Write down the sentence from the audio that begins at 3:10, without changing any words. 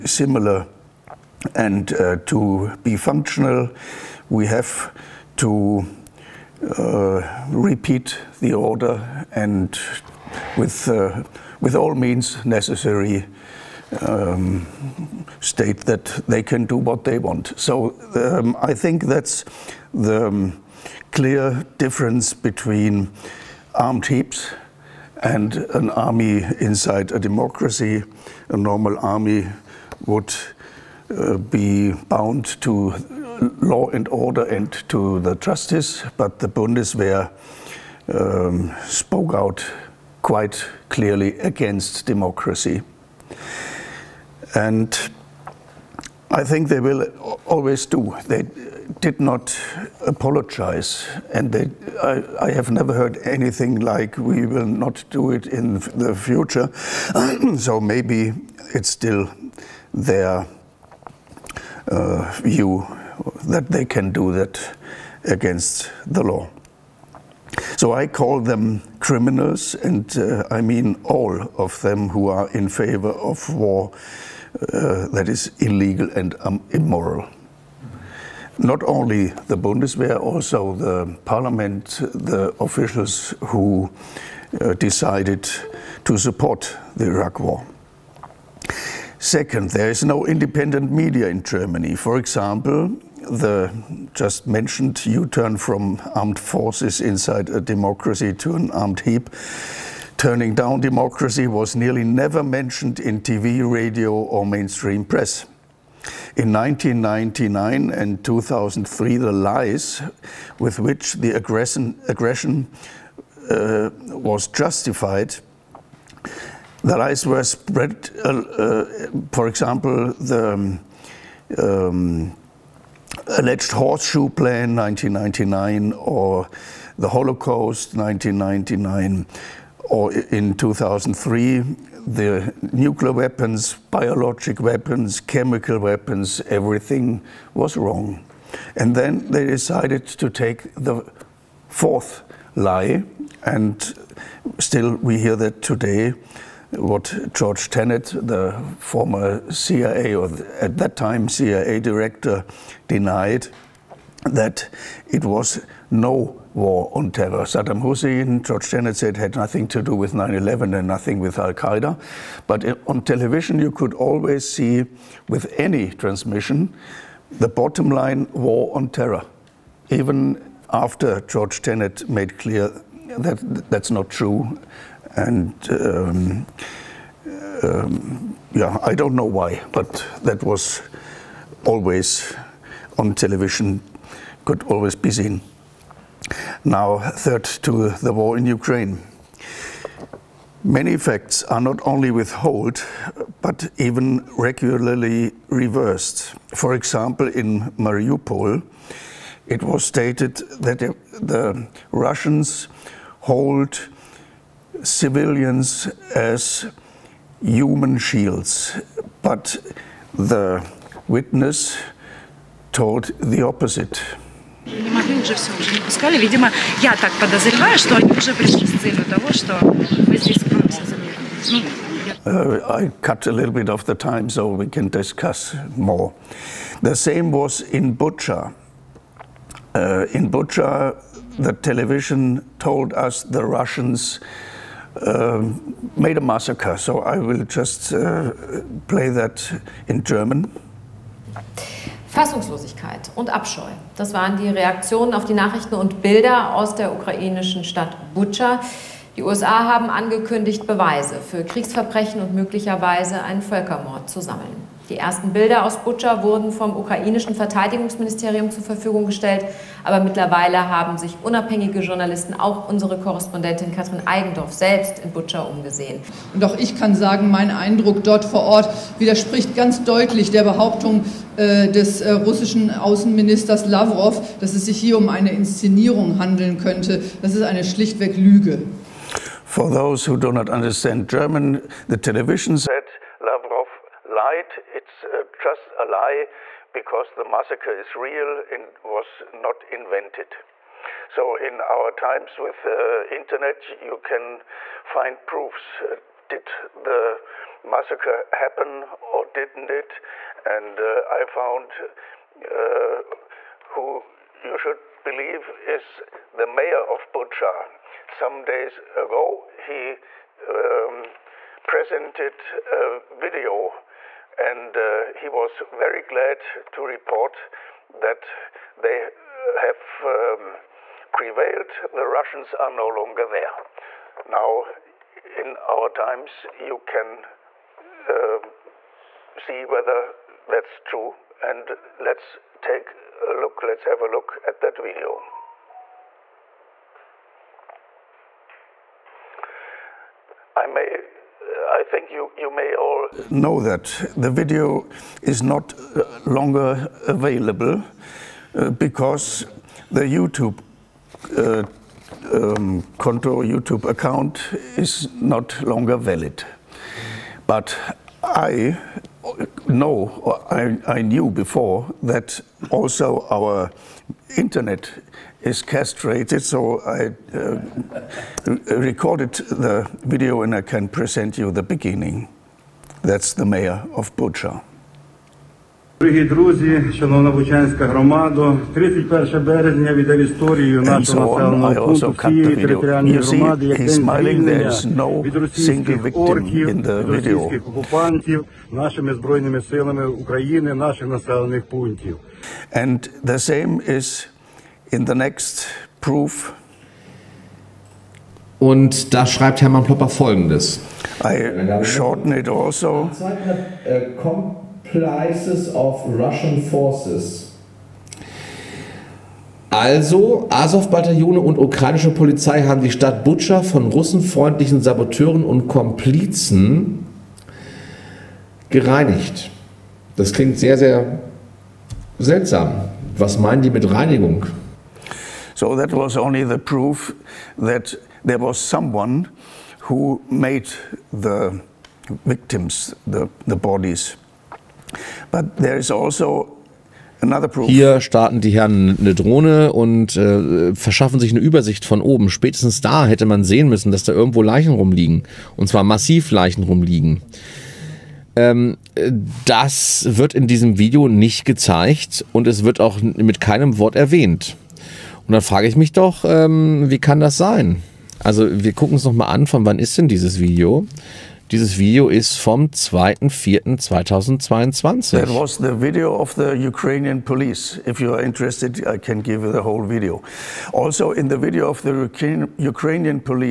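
Many facts are not only withheld, but even regularly reversed.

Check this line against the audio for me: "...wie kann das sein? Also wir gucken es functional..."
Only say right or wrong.
wrong.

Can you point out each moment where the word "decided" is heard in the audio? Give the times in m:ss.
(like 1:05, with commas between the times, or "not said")
1:24, 2:19.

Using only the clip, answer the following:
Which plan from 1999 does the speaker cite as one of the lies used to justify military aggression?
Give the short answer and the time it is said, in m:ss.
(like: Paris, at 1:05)
horseshoe plan, at 2:03.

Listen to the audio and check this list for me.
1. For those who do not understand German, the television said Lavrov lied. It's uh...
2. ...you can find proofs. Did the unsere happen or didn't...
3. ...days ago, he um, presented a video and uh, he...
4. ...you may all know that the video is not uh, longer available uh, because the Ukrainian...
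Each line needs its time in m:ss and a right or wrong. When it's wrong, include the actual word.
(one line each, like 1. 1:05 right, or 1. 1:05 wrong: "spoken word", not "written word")
1. 4:39 right
2. 4:53 wrong: "massacre", not "unsere"
3. 5:08 right
4. 5:42 wrong: "YouTube", not "Ukrainian".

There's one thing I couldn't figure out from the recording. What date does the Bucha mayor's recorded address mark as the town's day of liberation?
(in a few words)
31 March.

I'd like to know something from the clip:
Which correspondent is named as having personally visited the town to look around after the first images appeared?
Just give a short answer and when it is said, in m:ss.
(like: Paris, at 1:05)
Katrin Eigendorf, at 4:23.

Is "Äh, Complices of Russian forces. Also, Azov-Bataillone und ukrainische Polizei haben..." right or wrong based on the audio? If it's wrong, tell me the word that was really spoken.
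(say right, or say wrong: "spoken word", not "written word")
right.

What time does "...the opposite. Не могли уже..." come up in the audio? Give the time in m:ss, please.
3:33.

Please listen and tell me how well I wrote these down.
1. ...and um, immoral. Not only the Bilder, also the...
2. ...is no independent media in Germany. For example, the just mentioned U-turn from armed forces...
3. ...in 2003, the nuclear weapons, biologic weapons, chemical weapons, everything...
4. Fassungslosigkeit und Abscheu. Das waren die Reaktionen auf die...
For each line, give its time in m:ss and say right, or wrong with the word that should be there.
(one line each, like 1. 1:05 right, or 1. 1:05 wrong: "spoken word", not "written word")
1. 1:16 wrong: "Bundeswehr", not "Bilder"
2. 1:29 right
3. 2:10 right
4. 4:02 right.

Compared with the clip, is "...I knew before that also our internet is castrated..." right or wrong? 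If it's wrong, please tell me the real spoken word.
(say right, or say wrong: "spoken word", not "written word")
right.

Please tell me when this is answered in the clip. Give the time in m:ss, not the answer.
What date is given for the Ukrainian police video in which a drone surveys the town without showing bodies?
7:42.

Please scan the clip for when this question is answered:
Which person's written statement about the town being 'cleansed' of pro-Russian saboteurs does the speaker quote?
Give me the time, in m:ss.
6:39.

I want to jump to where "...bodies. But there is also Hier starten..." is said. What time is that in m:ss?
7:13.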